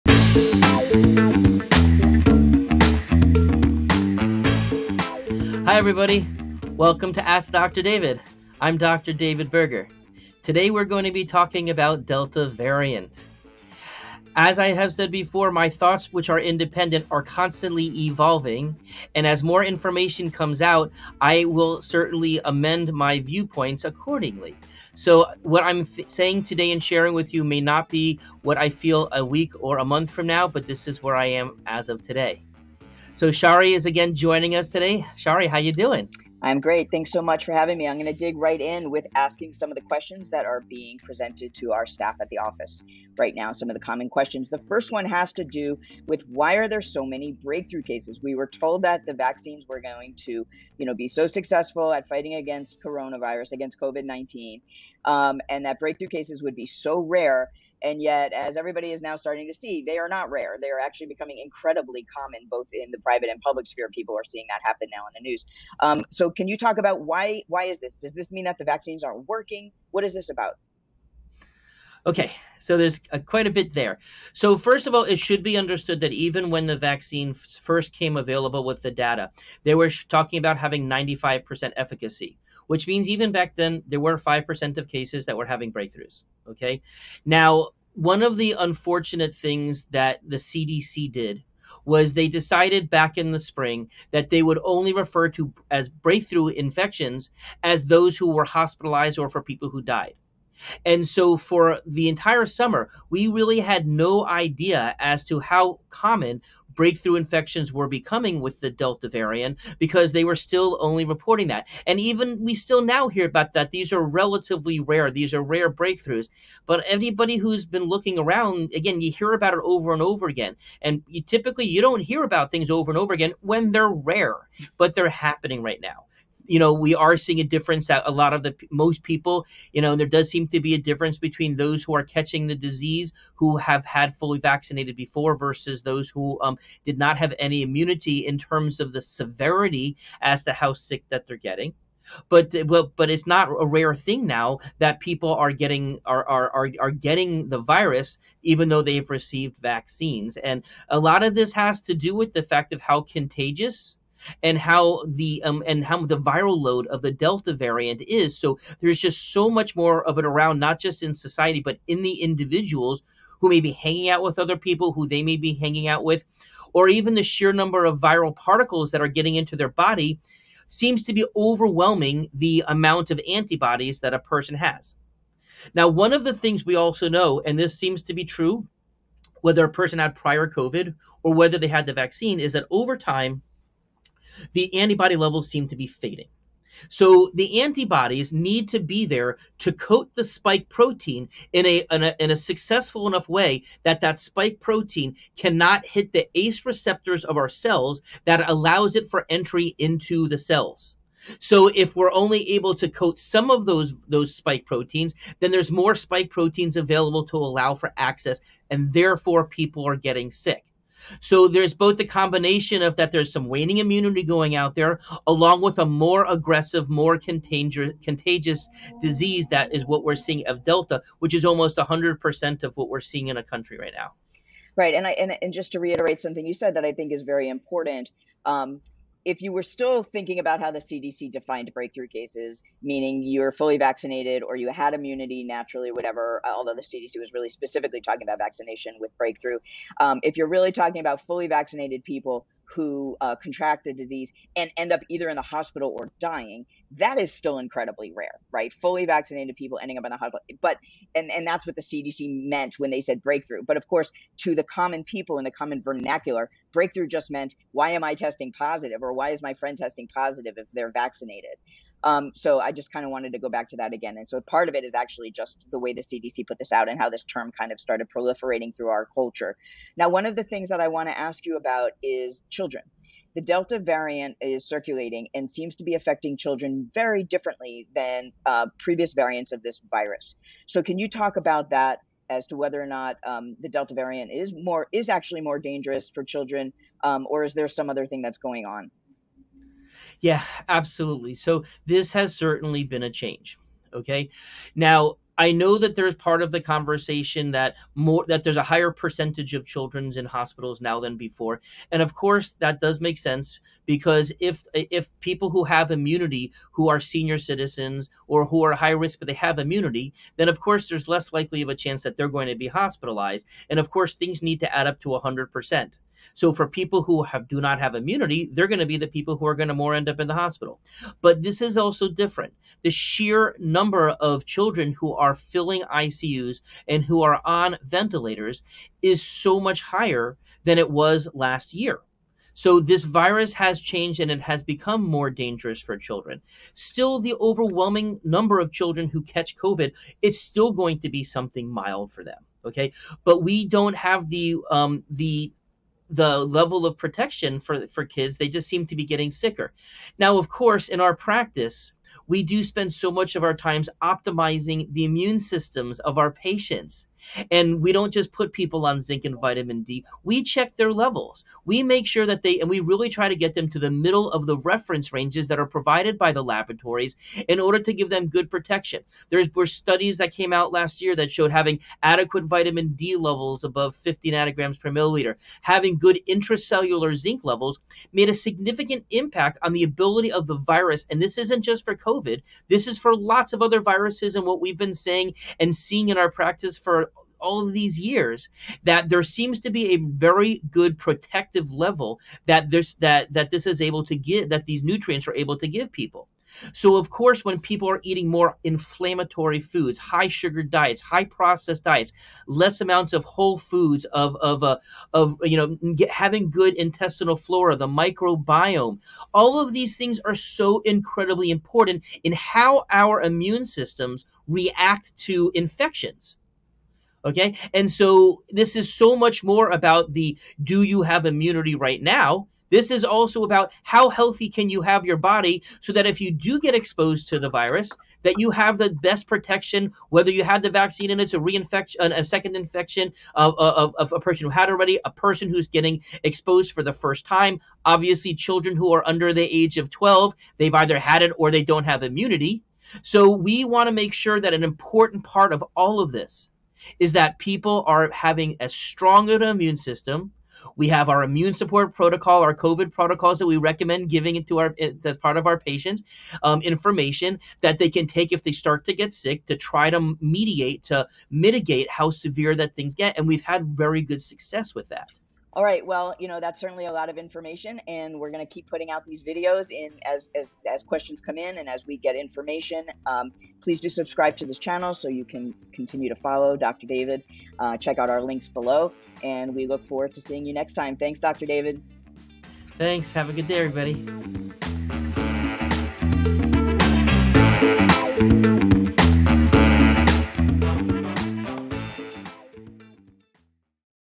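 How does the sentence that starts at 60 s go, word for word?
They are actually becoming incredibly common, both in the private and public sphere.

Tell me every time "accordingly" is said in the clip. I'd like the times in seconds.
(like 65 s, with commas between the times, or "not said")
23 s.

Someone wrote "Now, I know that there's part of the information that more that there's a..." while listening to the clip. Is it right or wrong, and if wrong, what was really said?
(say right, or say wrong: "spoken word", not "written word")
wrong: "conversation", not "information".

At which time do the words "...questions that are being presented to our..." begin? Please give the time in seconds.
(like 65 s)
39 s.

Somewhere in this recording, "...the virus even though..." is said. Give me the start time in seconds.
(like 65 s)
147 s.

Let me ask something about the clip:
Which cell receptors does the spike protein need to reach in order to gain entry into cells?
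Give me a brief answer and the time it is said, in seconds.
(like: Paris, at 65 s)
ACE receptors, at 196 s.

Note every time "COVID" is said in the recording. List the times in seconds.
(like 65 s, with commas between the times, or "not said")
53 s, 180 s, 339 s, 381 s, 452 s.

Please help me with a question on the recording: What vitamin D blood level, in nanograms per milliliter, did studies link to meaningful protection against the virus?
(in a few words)
50.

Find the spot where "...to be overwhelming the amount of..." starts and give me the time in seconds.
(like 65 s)
171 s.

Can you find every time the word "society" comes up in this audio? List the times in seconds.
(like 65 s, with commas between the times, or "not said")
161 s.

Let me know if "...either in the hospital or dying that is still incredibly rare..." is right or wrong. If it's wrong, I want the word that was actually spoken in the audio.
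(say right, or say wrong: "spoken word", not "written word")
right.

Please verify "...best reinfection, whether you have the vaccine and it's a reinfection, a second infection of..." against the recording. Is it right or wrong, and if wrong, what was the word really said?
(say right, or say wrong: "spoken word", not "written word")
wrong: "protection", not "reinfection".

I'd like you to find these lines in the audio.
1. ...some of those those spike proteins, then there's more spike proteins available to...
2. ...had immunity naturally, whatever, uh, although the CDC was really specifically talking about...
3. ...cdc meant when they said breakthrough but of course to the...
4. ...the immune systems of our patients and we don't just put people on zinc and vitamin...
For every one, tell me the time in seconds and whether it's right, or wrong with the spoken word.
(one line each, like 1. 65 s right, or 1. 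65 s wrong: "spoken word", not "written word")
1. 203 s right
2. 234 s right
3. 251 s right
4. 354 s right.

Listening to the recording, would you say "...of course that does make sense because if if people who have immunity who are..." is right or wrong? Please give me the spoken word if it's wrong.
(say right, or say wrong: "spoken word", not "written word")
right.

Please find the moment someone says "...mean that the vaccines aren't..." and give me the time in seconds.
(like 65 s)
68 s.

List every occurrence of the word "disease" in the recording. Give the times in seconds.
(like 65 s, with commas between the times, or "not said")
132 s, 219 s, 243 s.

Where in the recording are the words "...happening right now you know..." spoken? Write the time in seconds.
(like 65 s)
125 s.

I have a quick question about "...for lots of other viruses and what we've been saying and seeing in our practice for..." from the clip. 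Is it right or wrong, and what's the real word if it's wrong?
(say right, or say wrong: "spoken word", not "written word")
right.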